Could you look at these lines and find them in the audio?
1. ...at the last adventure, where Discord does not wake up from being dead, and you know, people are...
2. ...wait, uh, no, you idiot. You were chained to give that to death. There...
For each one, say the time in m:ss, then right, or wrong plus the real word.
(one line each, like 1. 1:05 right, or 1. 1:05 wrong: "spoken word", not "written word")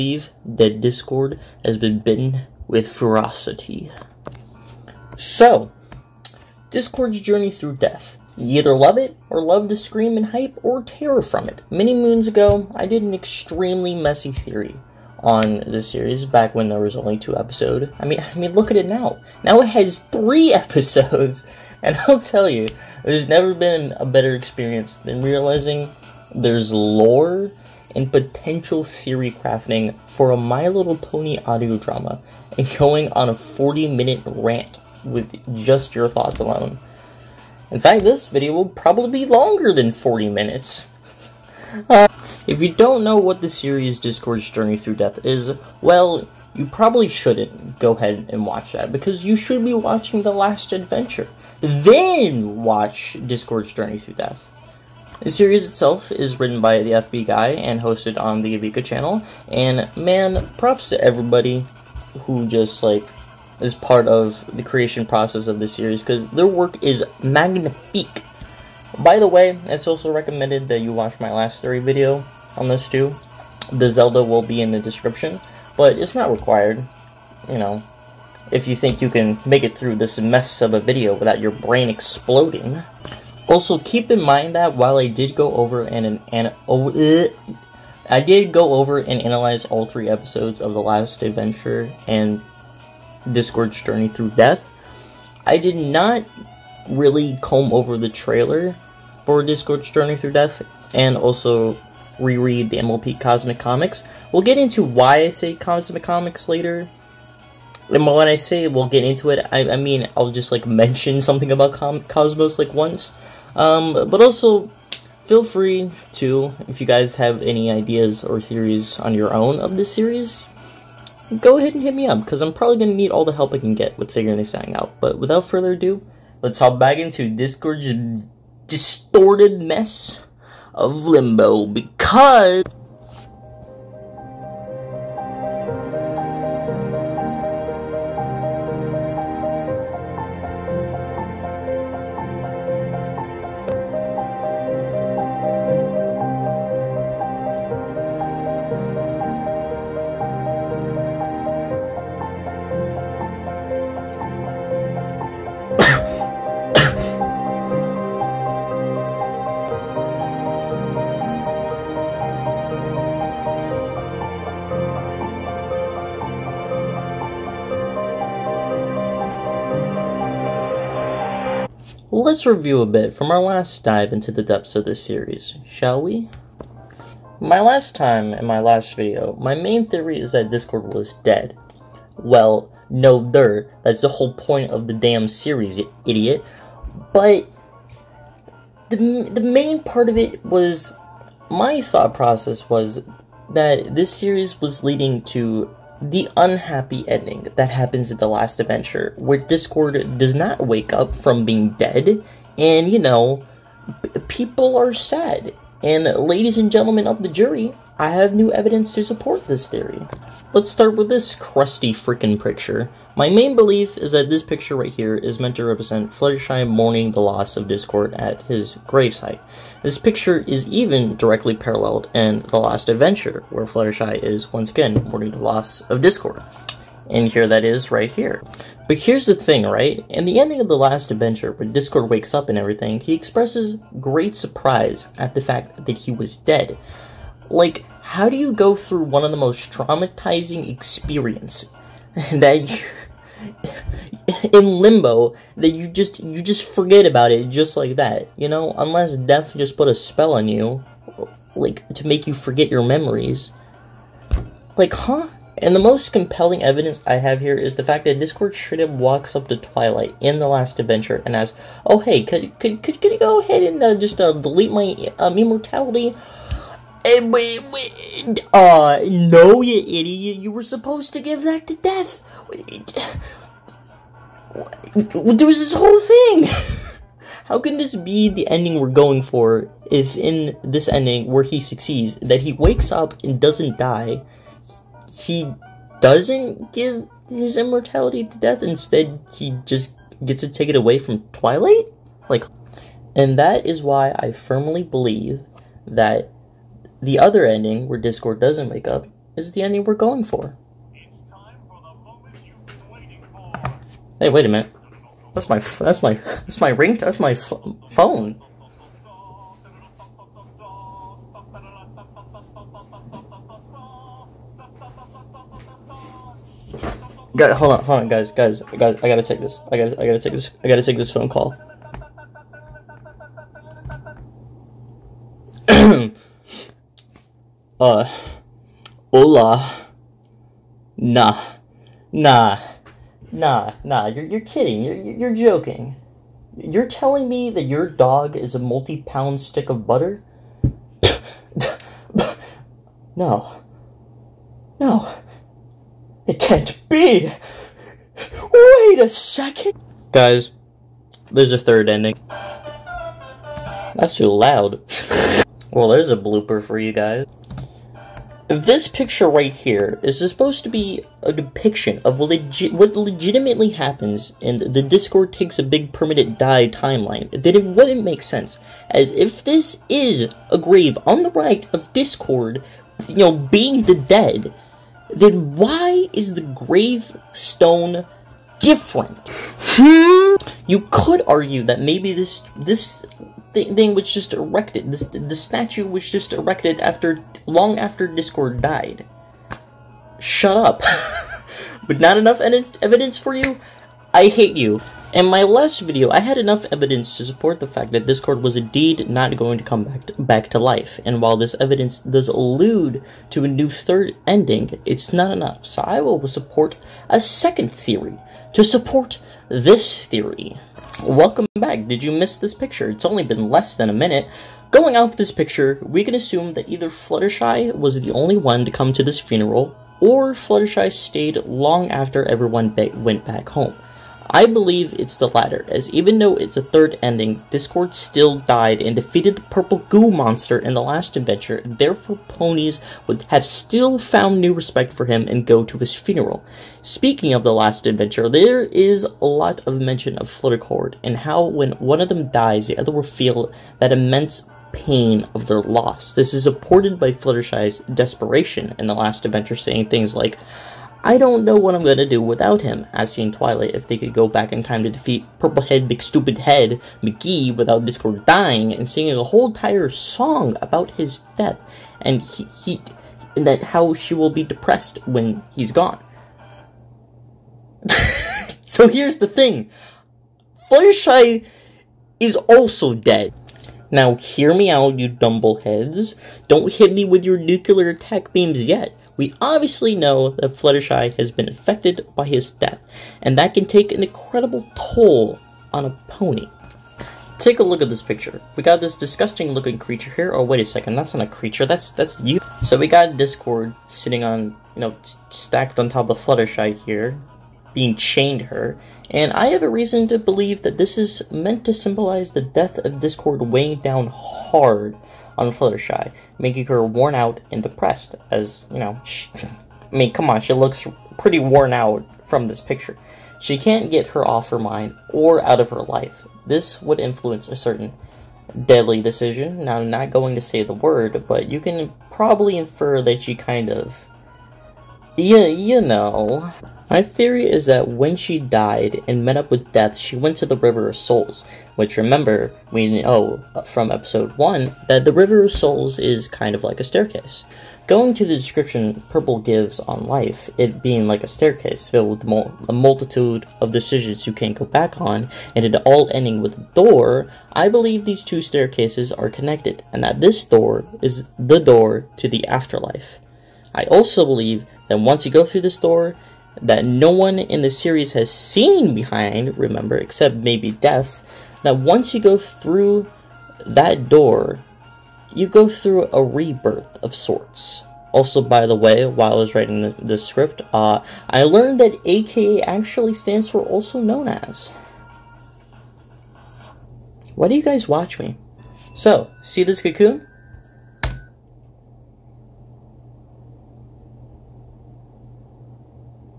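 1. 3:18 right
2. 4:27 wrong: "supposed", not "chained".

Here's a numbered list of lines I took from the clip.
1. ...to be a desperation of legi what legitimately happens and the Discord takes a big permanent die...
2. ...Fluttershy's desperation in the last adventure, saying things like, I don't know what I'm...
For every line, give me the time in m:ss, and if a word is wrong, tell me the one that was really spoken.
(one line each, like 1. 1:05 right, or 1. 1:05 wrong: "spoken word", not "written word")
1. 6:00 wrong: "depiction", not "desperation"
2. 7:27 right.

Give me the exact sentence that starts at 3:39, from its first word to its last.
This picture is even directly paralleled in The Last Adventure, where Fluttershy is once again mourning the loss of Discord.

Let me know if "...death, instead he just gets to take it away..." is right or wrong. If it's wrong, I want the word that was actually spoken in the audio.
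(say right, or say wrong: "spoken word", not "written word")
right.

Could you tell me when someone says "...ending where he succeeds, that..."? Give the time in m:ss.
4:40.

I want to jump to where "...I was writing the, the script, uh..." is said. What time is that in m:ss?
9:29.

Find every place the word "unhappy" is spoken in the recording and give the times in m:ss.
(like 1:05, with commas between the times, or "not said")
3:16.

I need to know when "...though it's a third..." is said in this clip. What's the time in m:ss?
7:06.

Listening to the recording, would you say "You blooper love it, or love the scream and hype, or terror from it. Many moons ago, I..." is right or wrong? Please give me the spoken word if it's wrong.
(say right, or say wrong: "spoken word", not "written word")
wrong: "either", not "blooper".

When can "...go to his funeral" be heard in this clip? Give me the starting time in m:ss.
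7:15.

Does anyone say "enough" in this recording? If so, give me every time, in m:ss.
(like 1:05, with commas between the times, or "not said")
6:32, 6:36, 6:45.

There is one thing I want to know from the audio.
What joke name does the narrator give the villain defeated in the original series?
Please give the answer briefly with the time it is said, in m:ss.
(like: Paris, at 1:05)
Purplehead Big Stupid Head McGee, at 7:35.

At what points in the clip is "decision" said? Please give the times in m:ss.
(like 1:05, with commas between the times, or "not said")
8:39, 9:03.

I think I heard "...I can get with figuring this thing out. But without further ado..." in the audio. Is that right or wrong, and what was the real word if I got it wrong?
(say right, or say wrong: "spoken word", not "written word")
right.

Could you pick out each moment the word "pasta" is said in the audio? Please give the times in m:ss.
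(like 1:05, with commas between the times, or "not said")
not said.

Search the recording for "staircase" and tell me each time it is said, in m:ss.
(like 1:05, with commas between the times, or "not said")
8:56, 9:01, 9:08.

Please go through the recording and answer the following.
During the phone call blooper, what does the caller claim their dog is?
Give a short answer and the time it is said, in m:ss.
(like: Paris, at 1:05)
A multi pound stick of butter, at 5:38.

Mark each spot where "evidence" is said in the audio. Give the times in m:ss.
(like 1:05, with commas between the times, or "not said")
3:28, 4:16, 6:32, 6:36, 6:41.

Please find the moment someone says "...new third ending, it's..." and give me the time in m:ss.
6:43.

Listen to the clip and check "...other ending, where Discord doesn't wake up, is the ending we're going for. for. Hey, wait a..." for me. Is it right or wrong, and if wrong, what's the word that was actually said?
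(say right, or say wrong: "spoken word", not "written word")
right.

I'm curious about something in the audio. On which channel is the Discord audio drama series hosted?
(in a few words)
Avika.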